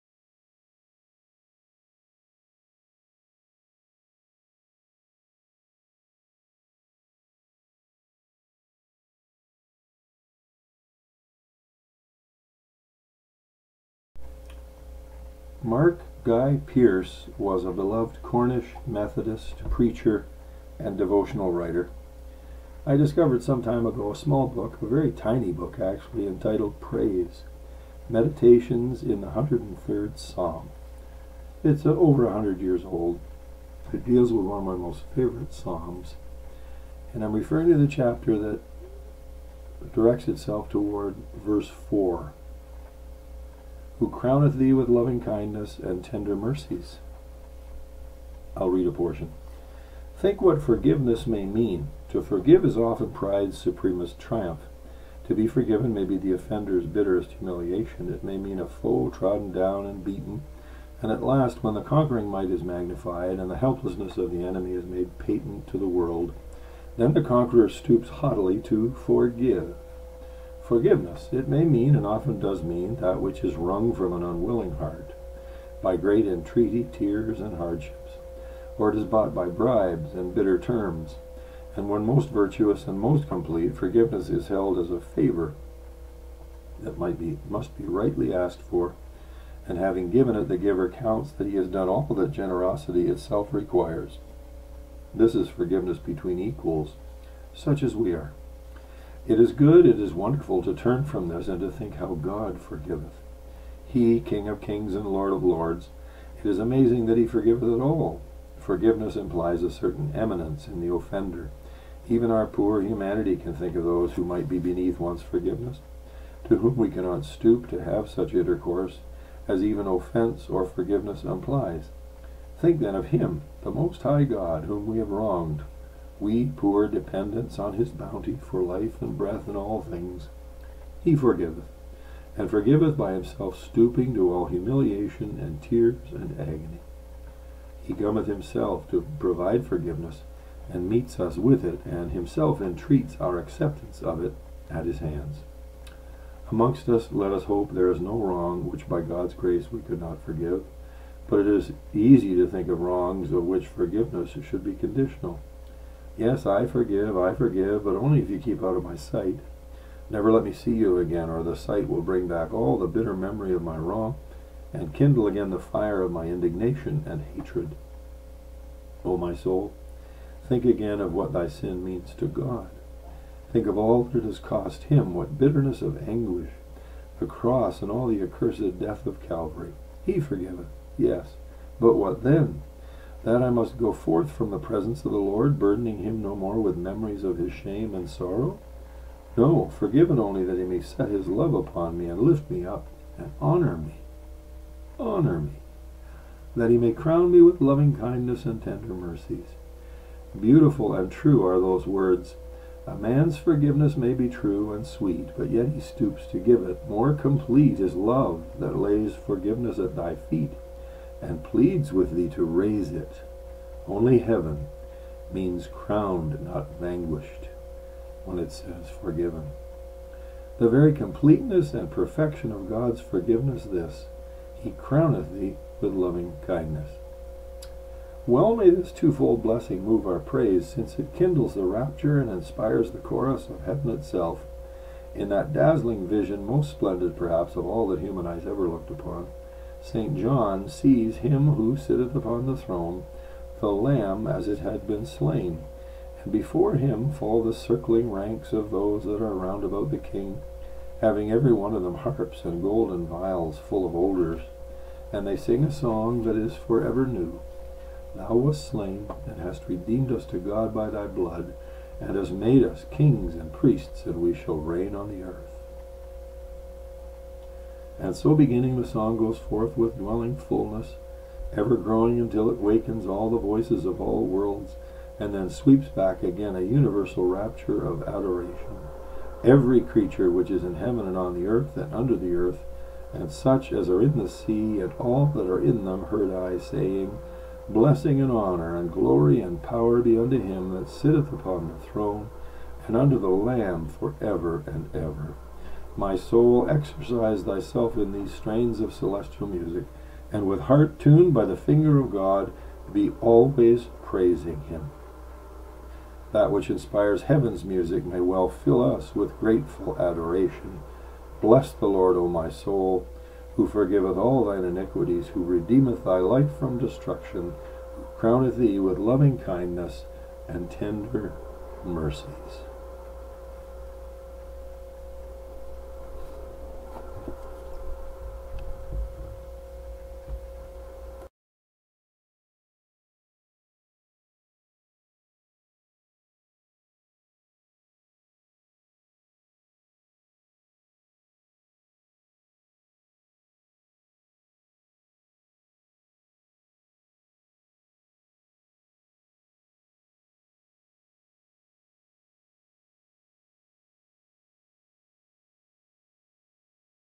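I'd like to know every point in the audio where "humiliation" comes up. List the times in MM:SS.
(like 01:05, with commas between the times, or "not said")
00:57, 02:14.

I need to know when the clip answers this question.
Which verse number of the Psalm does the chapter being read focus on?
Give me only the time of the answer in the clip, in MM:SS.
00:41.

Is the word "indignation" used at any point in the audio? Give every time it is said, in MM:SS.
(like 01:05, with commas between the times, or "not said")
02:46.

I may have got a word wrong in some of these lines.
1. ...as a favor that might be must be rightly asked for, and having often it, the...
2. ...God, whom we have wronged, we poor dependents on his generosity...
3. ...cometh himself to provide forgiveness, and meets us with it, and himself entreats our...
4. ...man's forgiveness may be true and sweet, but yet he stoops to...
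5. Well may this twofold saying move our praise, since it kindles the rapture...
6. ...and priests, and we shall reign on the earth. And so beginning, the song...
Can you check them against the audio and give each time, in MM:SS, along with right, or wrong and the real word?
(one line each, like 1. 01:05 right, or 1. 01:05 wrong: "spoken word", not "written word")
1. 01:24 wrong: "given", not "often"
2. 02:04 wrong: "bounty", not "generosity"
3. 02:17 right
4. 03:22 right
5. 03:48 wrong: "blessing", not "saying"
6. 04:23 right.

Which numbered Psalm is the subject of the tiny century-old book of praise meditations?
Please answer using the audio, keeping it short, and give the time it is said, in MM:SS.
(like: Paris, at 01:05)
103rd, at 00:29.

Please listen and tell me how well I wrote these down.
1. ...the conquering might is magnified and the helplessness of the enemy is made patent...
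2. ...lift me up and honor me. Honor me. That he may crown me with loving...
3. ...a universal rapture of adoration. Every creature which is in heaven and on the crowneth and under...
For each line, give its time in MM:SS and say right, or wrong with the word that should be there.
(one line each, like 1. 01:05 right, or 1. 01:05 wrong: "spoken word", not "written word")
1. 01:01 right
2. 03:12 right
3. 04:36 wrong: "earth", not "crowneth".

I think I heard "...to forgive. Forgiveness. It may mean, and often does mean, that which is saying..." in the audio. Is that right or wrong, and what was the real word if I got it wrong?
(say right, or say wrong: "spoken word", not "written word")
wrong: "wrung", not "saying".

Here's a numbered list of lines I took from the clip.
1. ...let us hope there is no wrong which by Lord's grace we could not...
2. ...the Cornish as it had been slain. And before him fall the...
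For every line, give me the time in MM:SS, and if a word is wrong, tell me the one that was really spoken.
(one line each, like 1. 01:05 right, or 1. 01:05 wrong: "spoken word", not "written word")
1. 02:27 wrong: "God", not "Lord"
2. 04:03 wrong: "Lamb", not "Cornish".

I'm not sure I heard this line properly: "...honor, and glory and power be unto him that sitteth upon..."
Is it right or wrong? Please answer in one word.
right.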